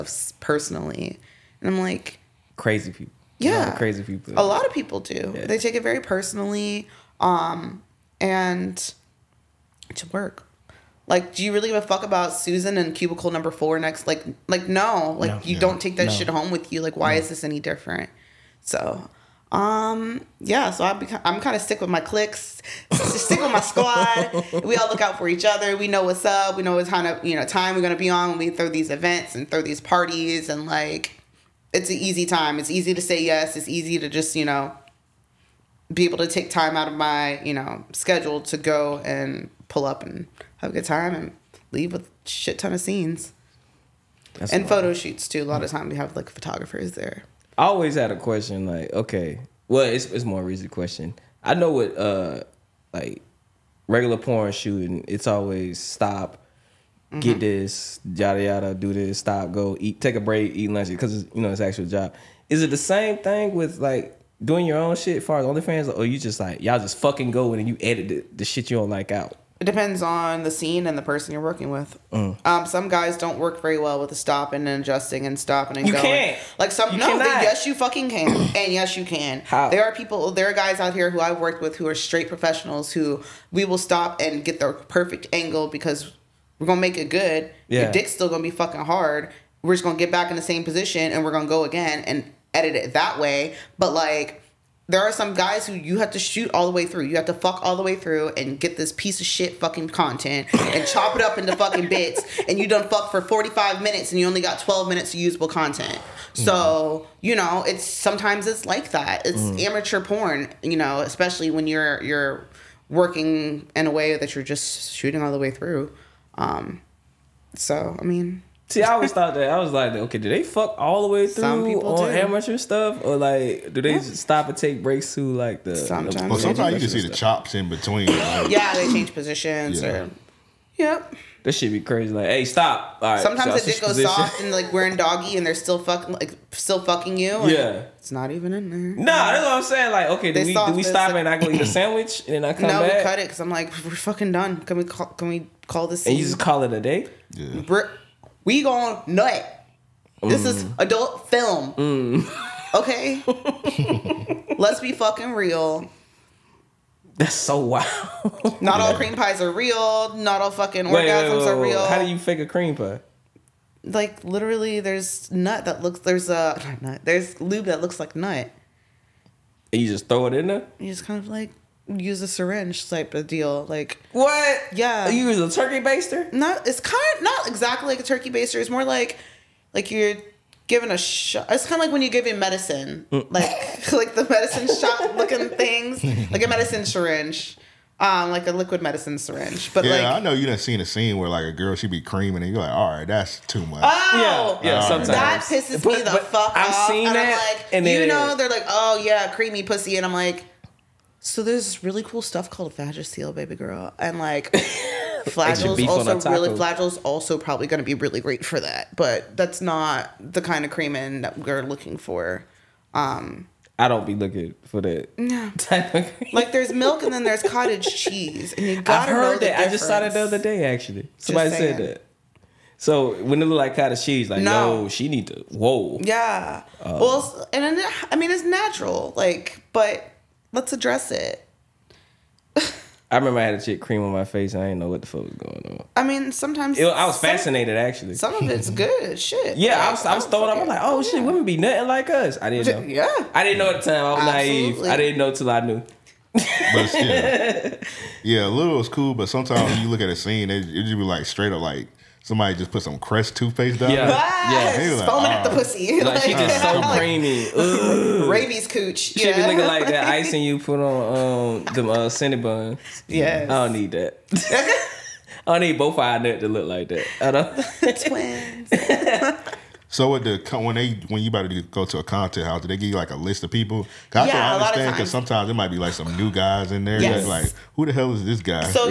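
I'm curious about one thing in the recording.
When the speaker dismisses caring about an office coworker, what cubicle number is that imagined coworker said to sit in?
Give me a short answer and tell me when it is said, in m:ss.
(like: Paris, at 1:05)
4, at 0:13.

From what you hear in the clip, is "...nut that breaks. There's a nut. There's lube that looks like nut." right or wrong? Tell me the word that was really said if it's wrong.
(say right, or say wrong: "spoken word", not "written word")
wrong: "looks", not "breaks".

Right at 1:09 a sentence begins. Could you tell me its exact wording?
It depends on the scene and the person you're working with.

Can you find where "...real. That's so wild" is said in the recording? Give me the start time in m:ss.
2:35.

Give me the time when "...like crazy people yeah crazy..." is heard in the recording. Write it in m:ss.
0:01.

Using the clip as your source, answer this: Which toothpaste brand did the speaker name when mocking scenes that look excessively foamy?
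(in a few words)
Crest.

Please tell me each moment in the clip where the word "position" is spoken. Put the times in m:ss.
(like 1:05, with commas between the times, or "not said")
1:30, 2:09, 2:13.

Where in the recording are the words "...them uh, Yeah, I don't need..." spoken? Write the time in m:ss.
4:21.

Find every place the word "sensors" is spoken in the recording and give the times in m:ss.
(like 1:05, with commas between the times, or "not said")
not said.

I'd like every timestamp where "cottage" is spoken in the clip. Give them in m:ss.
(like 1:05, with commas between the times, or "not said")
3:37, 3:43.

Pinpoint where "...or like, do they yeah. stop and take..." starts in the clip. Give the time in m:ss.
2:03.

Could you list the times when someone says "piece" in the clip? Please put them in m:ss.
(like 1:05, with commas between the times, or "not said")
1:38.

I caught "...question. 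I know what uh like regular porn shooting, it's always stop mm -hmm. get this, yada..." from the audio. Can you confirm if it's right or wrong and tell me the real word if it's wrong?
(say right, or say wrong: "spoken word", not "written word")
right.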